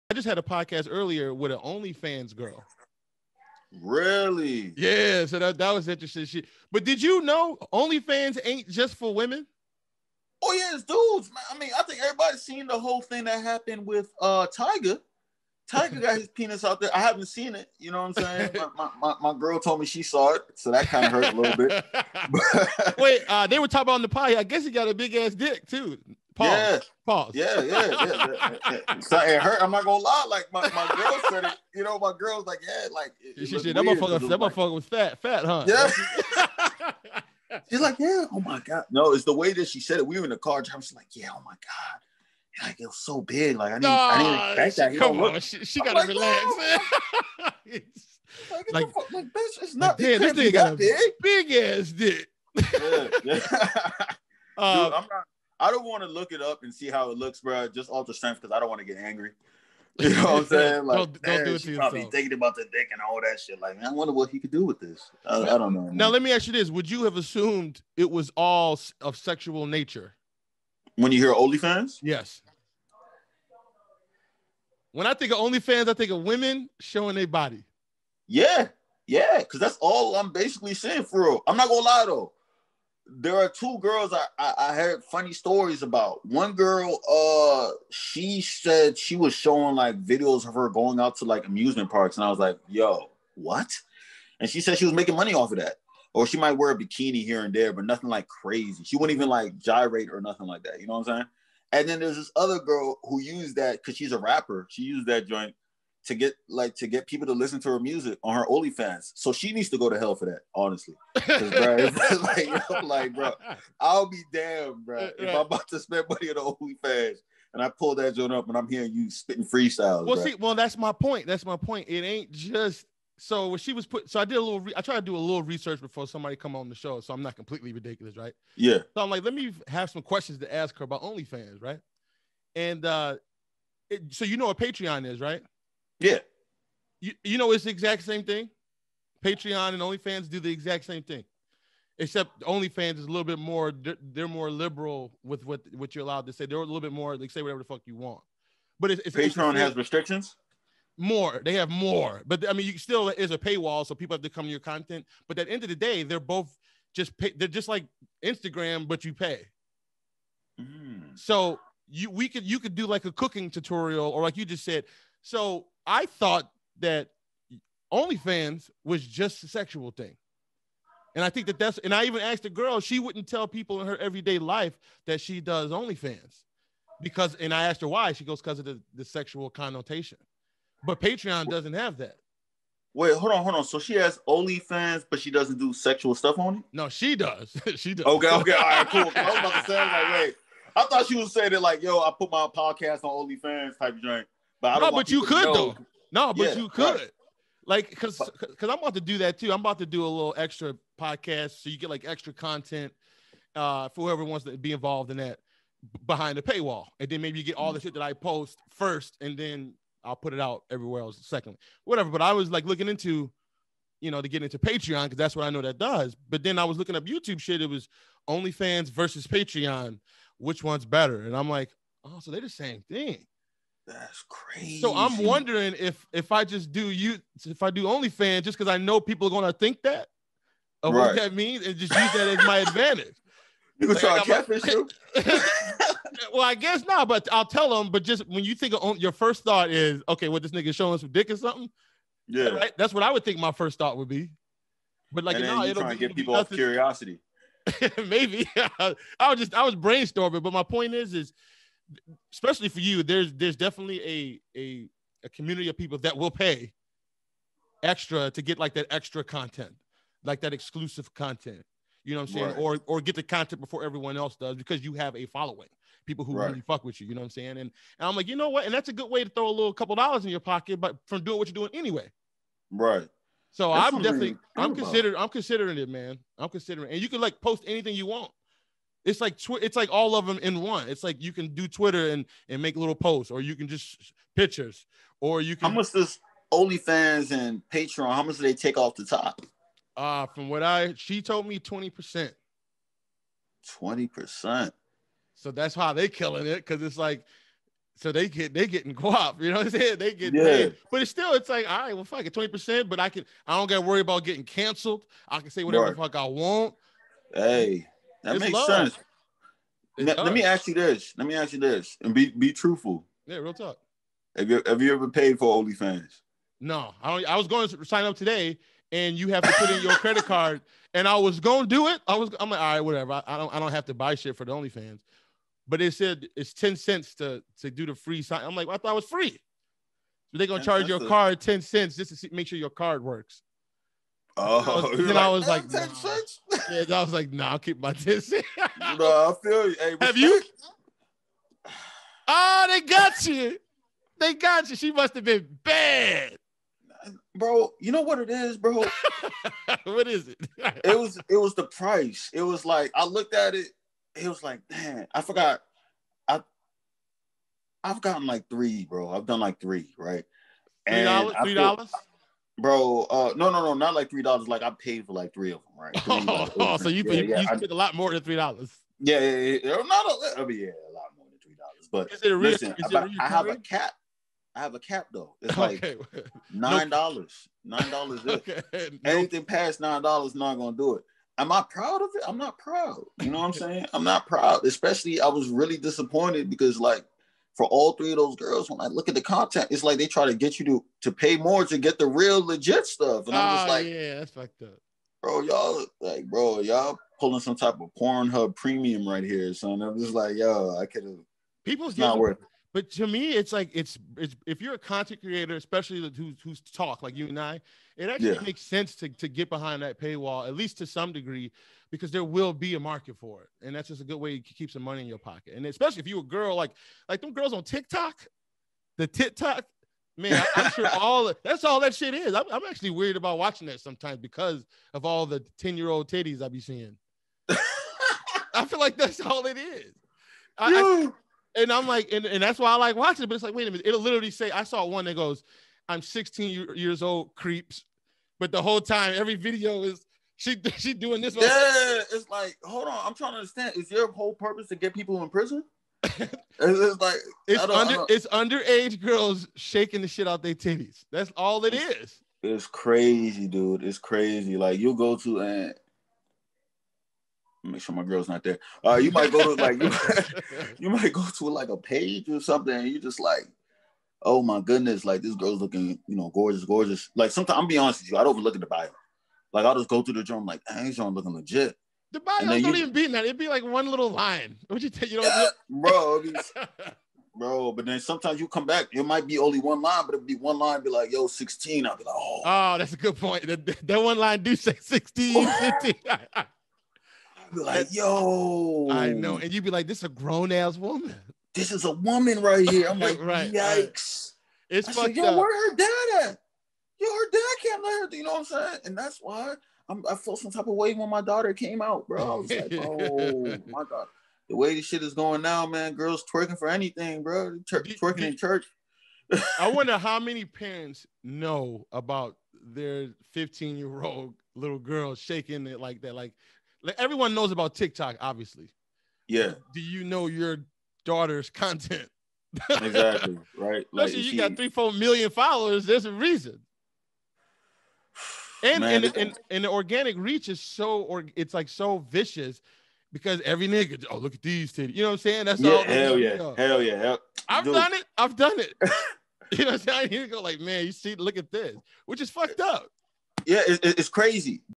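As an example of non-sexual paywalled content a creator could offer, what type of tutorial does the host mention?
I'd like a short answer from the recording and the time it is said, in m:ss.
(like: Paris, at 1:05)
cooking tutorial, at 2:43.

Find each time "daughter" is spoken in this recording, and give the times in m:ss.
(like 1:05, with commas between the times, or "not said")
8:21, 8:41.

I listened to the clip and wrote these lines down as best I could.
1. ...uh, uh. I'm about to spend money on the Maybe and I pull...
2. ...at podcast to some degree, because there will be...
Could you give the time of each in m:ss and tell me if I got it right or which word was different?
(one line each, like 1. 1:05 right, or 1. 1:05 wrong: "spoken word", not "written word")
1. 1:55 wrong: "OnlyFans", not "Maybe"
2. 6:50 wrong: "least", not "podcast".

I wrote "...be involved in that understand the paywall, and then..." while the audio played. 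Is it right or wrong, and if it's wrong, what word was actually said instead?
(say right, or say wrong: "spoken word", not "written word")
wrong: "behind", not "understand".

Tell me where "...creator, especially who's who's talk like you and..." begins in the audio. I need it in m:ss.
6:45.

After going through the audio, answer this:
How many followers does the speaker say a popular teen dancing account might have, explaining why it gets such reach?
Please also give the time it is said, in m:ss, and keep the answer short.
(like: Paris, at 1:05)
3 to 4 million, at 8:44.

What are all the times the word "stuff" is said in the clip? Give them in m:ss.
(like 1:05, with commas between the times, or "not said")
3:06, 6:32.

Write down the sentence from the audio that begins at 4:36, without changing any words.
I'm considering, and you can like post anything you want.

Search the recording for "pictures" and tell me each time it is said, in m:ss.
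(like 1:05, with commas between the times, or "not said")
4:44.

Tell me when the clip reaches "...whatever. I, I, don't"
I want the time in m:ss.
5:22.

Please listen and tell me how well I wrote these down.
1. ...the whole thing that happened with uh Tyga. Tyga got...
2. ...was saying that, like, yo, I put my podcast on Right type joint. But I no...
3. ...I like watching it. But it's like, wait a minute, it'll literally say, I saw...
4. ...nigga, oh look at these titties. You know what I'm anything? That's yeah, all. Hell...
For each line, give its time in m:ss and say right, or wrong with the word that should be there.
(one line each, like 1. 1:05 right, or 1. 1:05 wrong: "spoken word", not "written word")
1. 0:12 right
2. 3:11 wrong: "OnlyFans", not "Right"
3. 7:12 right
4. 8:53 wrong: "saying", not "anything".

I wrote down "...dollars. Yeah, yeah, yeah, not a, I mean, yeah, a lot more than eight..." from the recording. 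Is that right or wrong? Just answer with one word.
wrong.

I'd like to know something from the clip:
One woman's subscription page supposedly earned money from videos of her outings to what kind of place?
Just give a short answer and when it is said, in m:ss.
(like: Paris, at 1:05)
amusement parks, at 1:31.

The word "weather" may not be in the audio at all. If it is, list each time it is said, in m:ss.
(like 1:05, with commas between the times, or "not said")
not said.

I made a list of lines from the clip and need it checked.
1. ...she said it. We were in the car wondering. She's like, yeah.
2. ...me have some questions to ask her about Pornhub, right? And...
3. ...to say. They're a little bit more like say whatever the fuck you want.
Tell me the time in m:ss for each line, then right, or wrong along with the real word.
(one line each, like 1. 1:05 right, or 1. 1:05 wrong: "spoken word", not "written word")
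1. 0:39 wrong: "driving", not "wondering"
2. 2:09 wrong: "OnlyFans", not "Pornhub"
3. 2:26 right.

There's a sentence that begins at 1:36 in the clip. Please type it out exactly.
Or she might wear a bikini here and there, but nothing like crazy.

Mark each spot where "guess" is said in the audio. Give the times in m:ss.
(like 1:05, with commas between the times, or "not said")
0:24, 3:56.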